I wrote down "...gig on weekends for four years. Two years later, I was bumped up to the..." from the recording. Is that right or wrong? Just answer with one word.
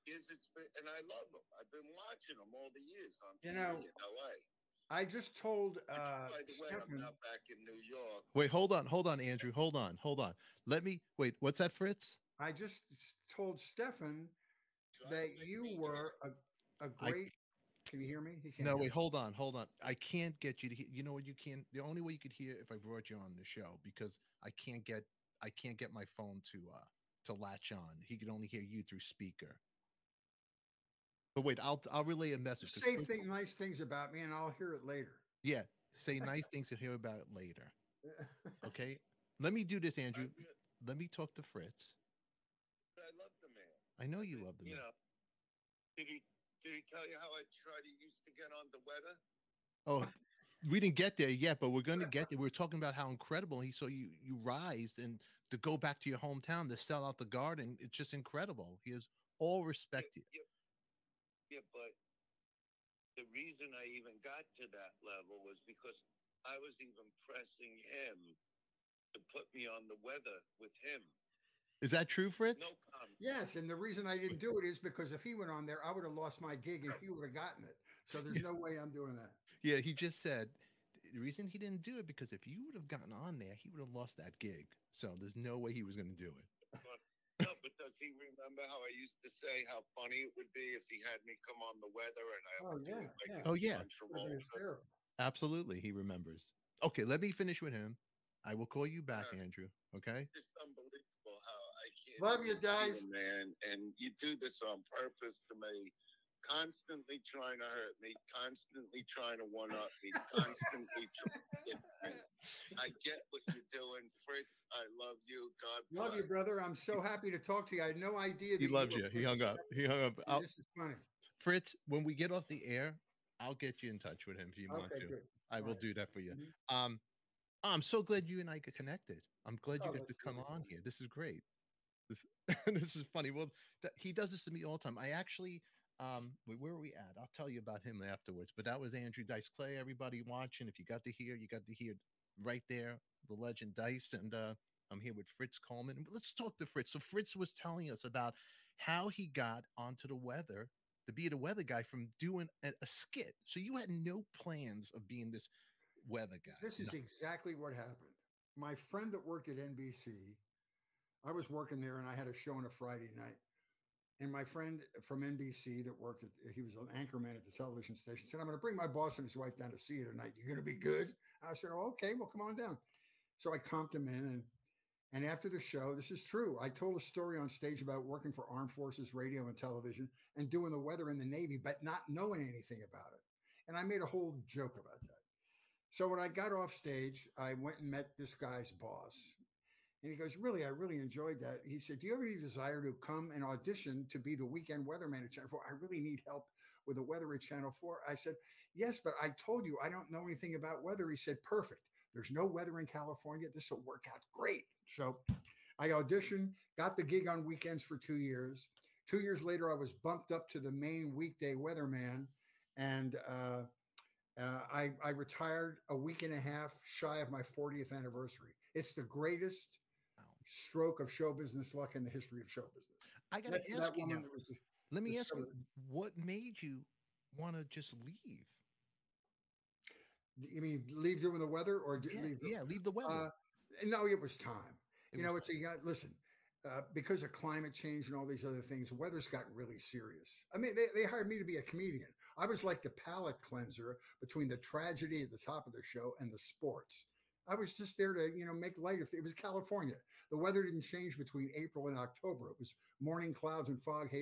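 wrong.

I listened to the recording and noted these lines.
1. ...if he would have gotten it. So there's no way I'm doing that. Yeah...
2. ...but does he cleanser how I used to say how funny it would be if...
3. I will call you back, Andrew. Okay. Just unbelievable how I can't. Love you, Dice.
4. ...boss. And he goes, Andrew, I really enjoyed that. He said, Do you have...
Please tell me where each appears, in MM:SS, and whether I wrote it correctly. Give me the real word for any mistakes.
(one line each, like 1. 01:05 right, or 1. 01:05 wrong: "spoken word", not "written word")
1. 01:16 right
2. 01:27 wrong: "remember", not "cleanser"
3. 01:38 right
4. 03:08 wrong: "Really", not "Andrew".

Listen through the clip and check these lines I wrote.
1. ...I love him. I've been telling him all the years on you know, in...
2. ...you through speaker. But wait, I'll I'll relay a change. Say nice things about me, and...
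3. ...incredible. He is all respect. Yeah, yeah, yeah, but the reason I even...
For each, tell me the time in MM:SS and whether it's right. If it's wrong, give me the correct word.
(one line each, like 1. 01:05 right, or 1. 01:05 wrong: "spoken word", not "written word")
1. 00:00 wrong: "watching", not "telling"
2. 00:28 wrong: "message", not "change"
3. 00:58 right.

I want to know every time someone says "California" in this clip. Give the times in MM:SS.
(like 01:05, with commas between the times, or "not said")
03:22, 04:09.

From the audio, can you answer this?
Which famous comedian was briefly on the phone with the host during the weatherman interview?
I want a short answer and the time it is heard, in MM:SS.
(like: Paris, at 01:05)
Andrew Dice Clay, at 02:18.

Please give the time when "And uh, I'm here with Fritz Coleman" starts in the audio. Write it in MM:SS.
02:24.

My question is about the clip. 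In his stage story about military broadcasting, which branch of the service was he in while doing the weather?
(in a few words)
Navy.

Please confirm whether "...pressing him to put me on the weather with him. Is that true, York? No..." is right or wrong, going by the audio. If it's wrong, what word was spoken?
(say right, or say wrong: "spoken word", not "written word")
wrong: "Fritz", not "York".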